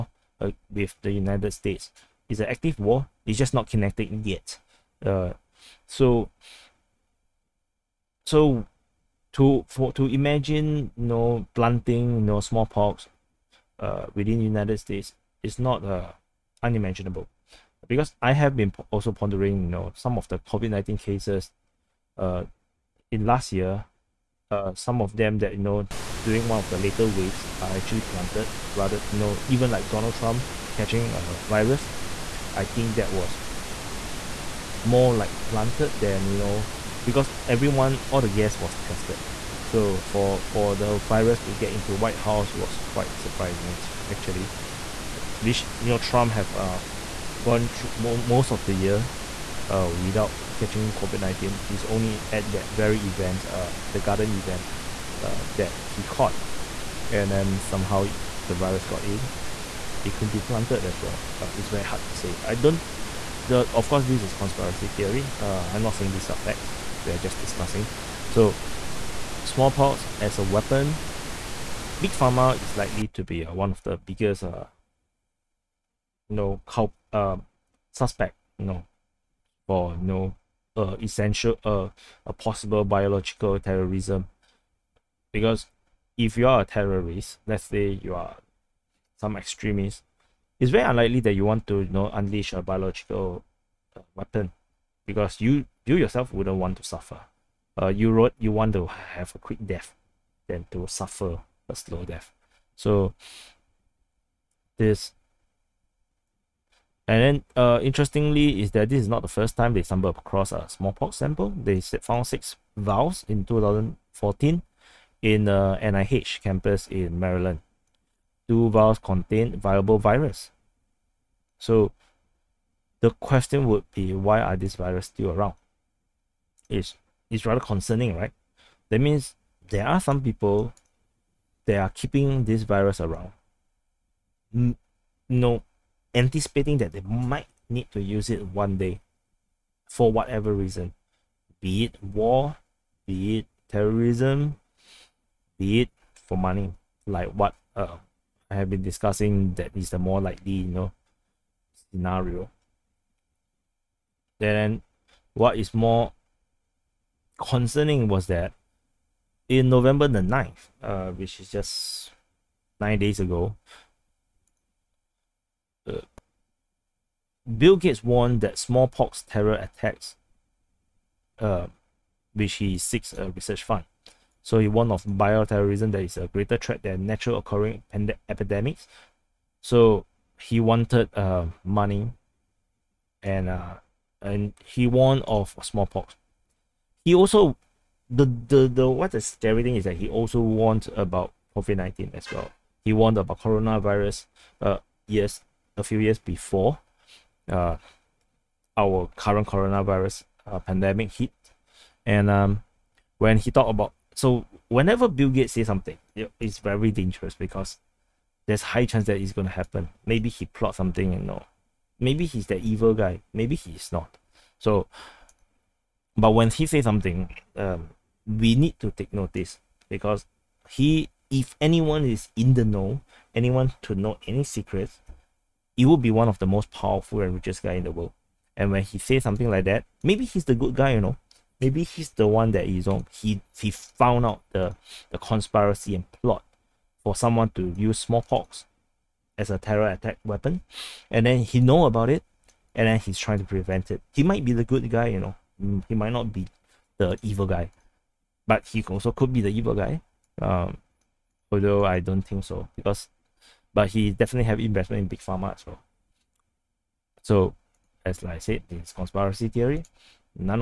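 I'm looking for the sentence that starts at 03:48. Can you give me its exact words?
And when he says something like that, maybe he's the good guy, you know.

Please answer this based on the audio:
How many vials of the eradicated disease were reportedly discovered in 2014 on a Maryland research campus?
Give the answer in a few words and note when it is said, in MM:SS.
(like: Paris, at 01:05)
6, at 01:52.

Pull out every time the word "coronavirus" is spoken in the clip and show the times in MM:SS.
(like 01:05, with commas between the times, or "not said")
03:13, 03:19.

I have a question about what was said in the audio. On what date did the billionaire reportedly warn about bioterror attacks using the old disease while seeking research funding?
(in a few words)
November 9.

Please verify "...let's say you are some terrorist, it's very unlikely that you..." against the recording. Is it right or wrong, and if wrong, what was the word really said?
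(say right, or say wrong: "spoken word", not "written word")
wrong: "extremist", not "terrorist".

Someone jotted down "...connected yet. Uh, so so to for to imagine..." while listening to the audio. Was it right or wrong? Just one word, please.
right.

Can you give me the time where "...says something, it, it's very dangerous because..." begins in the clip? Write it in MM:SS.
03:25.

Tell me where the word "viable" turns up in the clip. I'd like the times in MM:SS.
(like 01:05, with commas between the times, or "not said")
01:59.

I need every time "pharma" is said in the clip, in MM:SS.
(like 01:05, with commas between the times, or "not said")
01:12, 04:15.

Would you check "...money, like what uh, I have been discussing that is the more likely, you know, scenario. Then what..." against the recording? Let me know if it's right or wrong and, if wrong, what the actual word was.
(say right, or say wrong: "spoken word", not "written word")
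right.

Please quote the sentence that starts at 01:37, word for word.
Uh, you wrote you want to have a quick death than to suffer a slow death.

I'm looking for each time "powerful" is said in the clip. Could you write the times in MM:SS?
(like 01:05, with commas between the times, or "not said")
03:46.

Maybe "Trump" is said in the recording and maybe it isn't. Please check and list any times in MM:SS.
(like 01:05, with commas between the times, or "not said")
00:30, 00:45.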